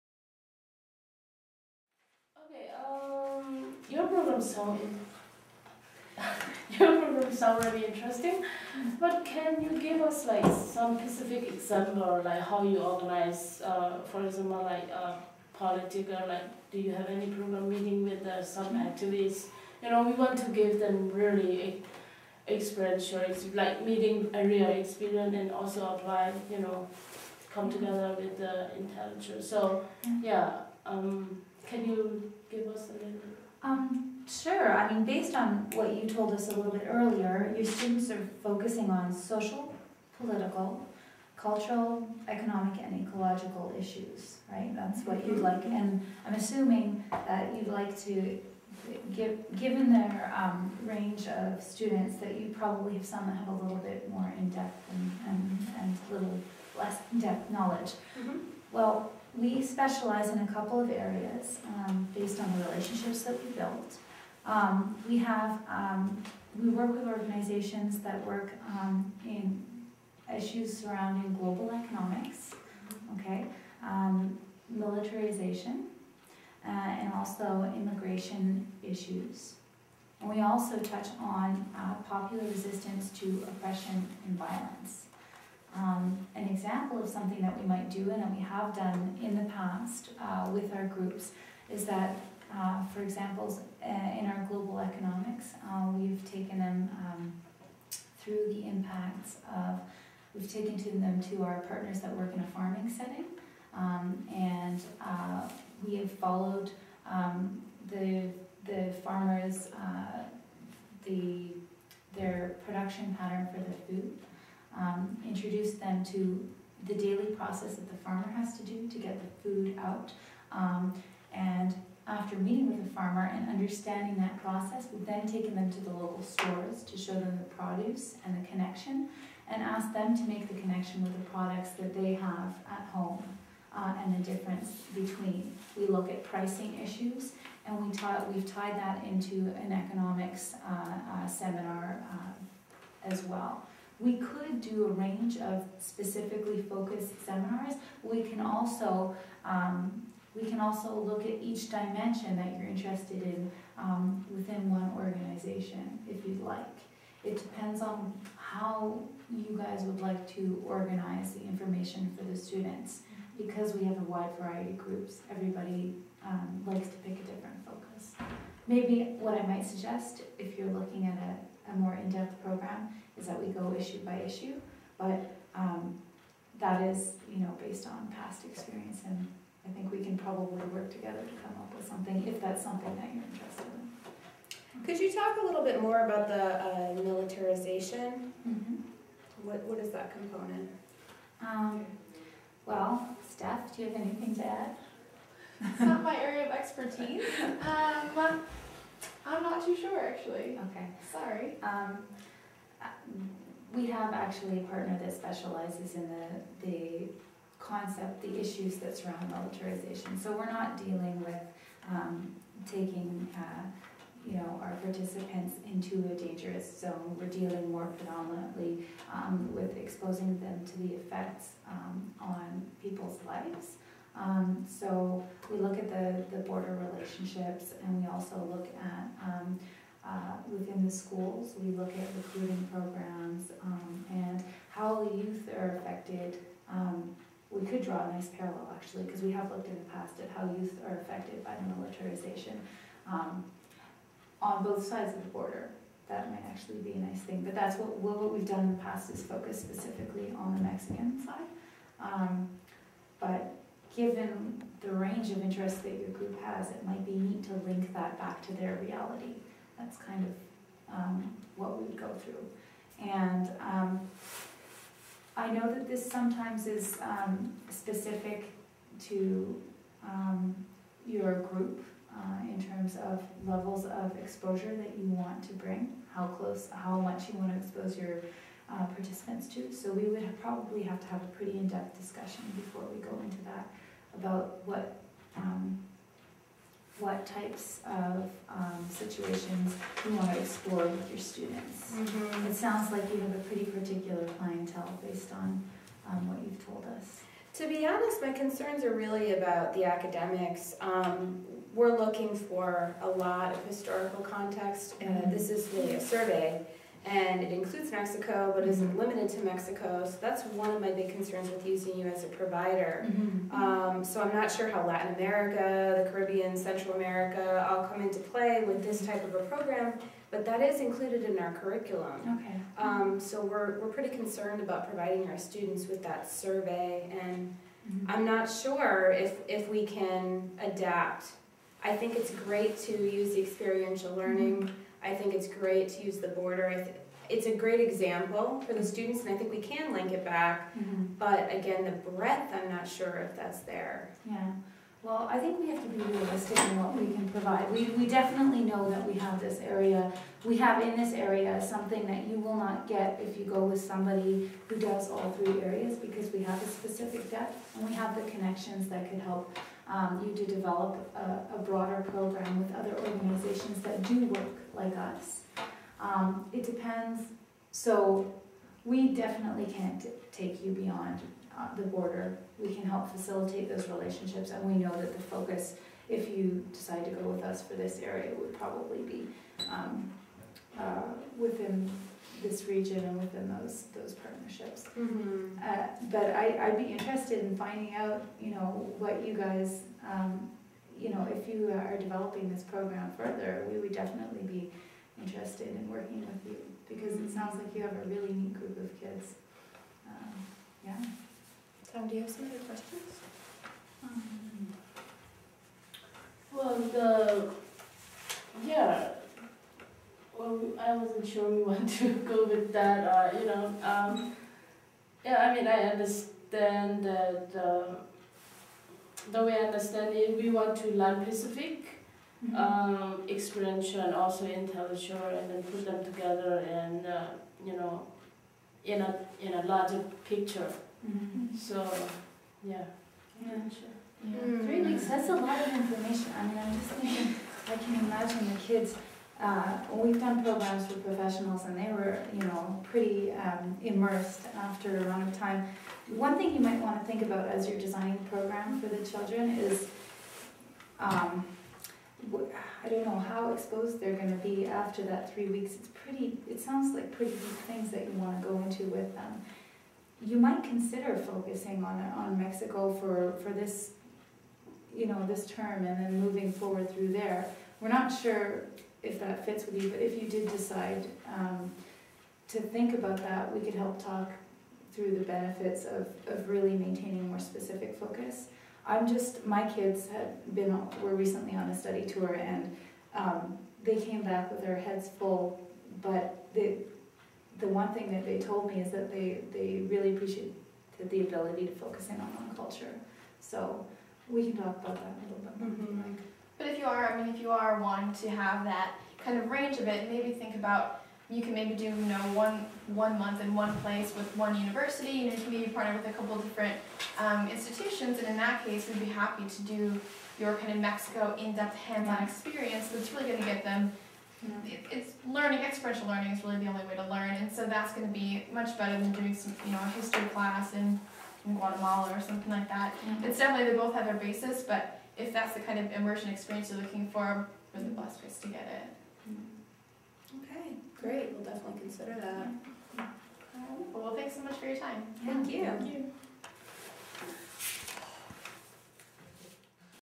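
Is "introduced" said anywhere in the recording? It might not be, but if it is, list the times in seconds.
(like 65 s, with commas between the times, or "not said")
115 s.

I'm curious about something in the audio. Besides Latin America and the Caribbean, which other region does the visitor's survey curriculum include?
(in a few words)
Central America.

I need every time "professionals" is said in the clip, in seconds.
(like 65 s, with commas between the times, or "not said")
440 s.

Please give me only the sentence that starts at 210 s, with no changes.
So we're not dealing with um, taking uh, you know, our participants into a dangerous zone.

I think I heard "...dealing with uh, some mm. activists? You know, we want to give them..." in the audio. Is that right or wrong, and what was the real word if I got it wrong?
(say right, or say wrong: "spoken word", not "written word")
wrong: "meeting", not "dealing".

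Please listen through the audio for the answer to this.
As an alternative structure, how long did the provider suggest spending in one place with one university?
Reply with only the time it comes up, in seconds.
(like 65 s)
502 s.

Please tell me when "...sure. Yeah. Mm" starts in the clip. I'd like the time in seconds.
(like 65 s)
433 s.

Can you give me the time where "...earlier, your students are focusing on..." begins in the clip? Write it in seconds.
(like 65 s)
36 s.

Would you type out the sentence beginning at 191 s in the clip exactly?
Um, well, Steph, do you have anything to add?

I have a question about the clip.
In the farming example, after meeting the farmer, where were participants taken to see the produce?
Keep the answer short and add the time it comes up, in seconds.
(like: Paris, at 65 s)
local stores, at 125 s.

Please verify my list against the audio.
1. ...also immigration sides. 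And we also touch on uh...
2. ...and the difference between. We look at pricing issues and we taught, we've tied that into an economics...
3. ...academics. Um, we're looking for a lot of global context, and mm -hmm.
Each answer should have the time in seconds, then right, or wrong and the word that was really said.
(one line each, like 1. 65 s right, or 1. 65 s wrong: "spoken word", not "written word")
1. 77 s wrong: "issues", not "sides"
2. 134 s right
3. 299 s wrong: "historical", not "global".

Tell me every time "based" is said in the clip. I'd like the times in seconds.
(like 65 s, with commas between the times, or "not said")
35 s, 62 s, 177 s, 295 s.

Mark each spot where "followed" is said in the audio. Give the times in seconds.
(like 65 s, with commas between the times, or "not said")
106 s.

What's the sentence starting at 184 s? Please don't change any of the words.
Could you talk a little bit more about the uh, militarization?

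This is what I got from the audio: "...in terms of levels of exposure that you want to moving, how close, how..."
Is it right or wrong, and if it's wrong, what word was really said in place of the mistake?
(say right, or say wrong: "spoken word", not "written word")
wrong: "bring", not "moving".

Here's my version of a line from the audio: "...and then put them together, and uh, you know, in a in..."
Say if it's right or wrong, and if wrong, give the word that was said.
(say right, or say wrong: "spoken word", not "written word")
right.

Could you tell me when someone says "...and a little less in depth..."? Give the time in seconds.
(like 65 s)
55 s.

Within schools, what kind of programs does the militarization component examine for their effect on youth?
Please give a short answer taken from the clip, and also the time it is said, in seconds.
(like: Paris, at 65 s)
recruiting programs, at 232 s.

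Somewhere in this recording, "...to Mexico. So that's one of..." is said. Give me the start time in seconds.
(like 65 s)
309 s.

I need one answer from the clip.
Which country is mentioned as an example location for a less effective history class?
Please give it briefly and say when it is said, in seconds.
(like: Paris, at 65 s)
Guatemala, at 521 s.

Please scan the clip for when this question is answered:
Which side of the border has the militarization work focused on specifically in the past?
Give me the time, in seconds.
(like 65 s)
250 s.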